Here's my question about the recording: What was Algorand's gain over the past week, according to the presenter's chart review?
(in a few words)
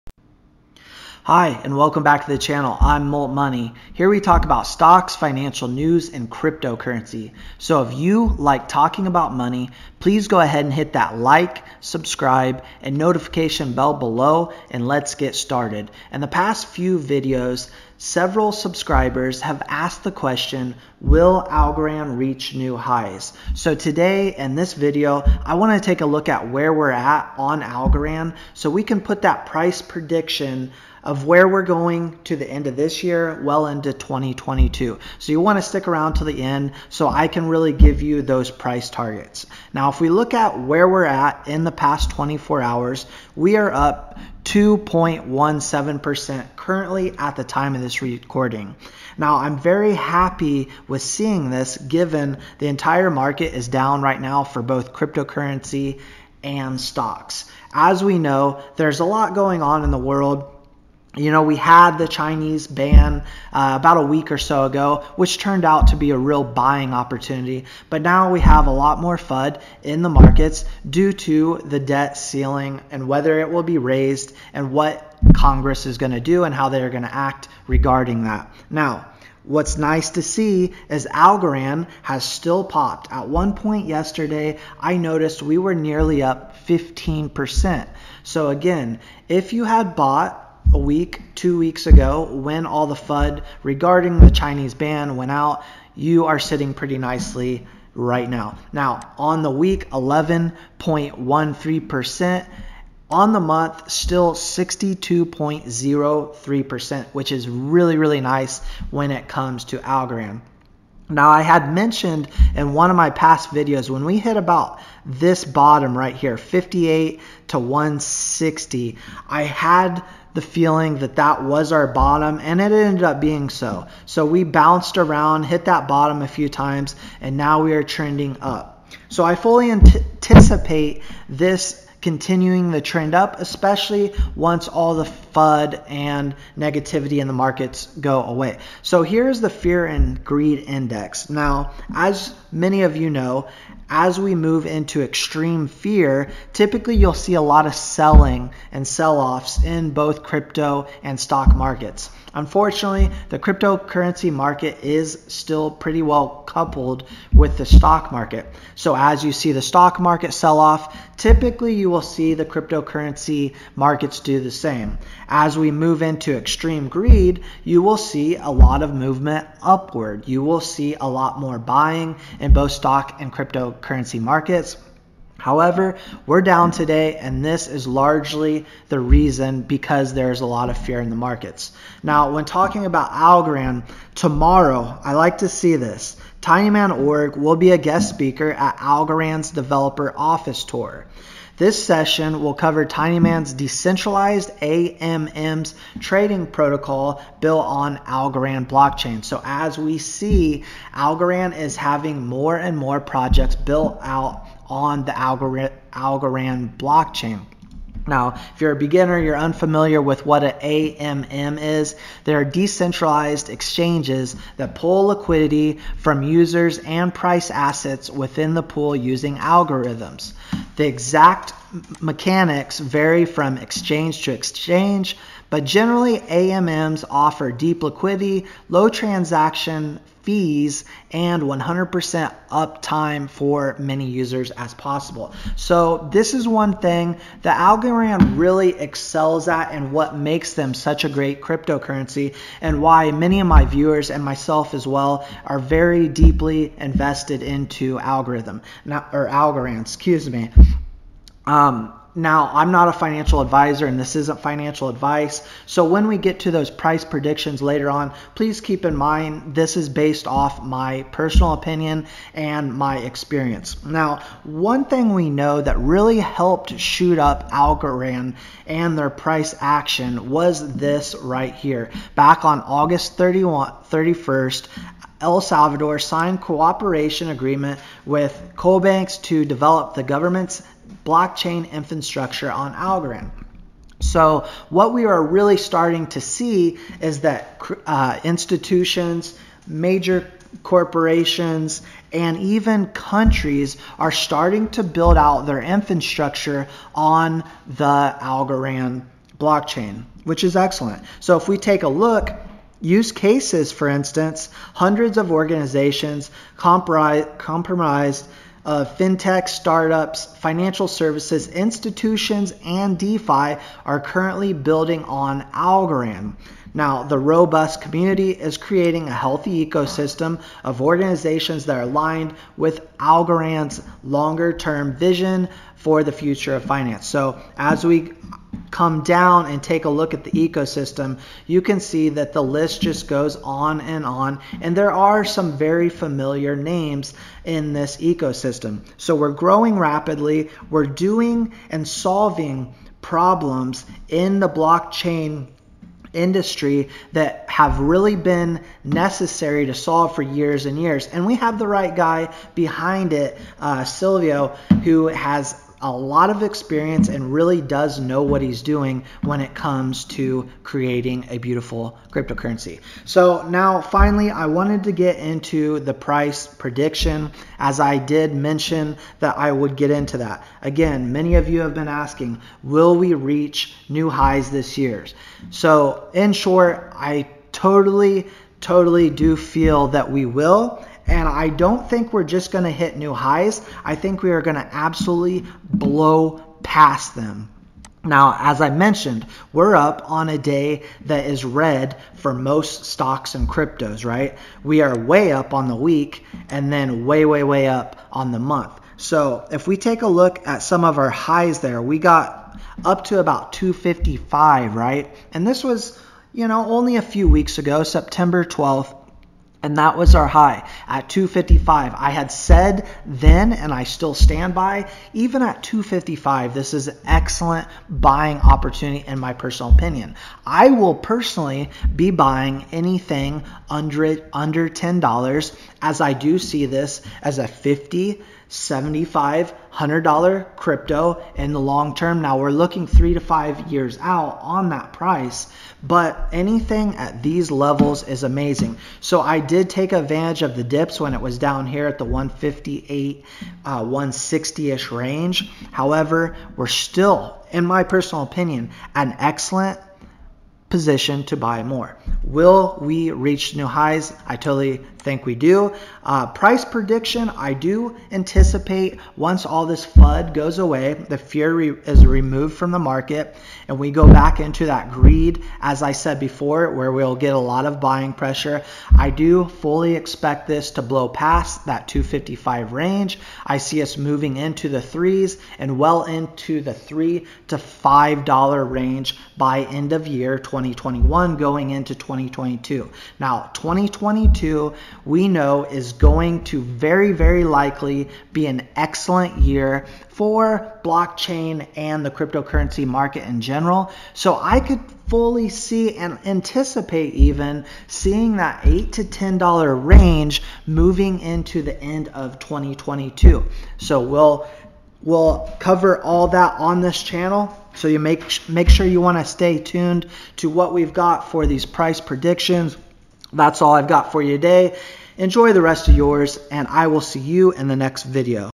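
11.13%.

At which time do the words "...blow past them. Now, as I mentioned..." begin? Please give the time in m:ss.
6:25.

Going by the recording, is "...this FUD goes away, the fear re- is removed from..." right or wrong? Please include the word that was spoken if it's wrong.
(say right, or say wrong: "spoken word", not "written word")
right.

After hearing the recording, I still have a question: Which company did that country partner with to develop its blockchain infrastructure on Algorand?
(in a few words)
Koibanx.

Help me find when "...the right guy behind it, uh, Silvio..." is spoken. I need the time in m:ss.
5:51.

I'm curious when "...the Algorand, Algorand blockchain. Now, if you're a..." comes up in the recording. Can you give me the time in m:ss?
3:25.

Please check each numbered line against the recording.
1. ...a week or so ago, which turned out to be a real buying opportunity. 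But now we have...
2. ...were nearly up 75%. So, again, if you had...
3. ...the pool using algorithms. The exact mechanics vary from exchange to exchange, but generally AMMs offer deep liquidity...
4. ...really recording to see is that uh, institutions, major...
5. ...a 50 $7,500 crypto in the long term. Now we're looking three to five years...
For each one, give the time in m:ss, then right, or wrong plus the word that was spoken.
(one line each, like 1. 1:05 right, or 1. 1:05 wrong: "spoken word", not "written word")
1. 1:03 right
2. 1:25 wrong: "15", not "75"
3. 3:38 right
4. 4:45 wrong: "starting", not "recording"
5. 7:07 right.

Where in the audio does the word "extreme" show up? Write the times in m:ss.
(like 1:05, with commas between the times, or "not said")
2:25, 2:46.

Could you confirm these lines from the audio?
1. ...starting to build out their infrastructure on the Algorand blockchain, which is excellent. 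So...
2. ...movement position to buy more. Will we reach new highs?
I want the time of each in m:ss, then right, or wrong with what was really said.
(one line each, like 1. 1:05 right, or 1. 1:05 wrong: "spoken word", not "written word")
1. 4:54 right
2. 7:29 wrong: "excellent", not "movement".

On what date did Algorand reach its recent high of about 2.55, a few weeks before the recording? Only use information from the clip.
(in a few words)
September 12th.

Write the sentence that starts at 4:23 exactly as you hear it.
Now, one thing we know that really helped shoot up Algorand and their price action was this right here.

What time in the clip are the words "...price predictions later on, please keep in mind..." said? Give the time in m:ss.
4:16.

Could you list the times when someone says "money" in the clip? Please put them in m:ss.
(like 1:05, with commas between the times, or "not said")
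0:03, 0:09.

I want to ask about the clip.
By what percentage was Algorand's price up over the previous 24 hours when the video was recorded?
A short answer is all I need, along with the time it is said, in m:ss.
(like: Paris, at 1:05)
2.17%, at 0:44.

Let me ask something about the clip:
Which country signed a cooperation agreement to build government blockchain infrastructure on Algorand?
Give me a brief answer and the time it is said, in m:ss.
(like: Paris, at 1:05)
El Salvador, at 4:35.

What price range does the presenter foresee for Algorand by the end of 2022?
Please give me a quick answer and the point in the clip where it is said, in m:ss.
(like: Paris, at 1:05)
$8 to $10, at 8:18.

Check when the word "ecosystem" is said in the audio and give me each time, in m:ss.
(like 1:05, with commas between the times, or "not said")
5:19, 5:30, 5:37.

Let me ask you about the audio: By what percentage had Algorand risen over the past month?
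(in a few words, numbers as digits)
62.03%.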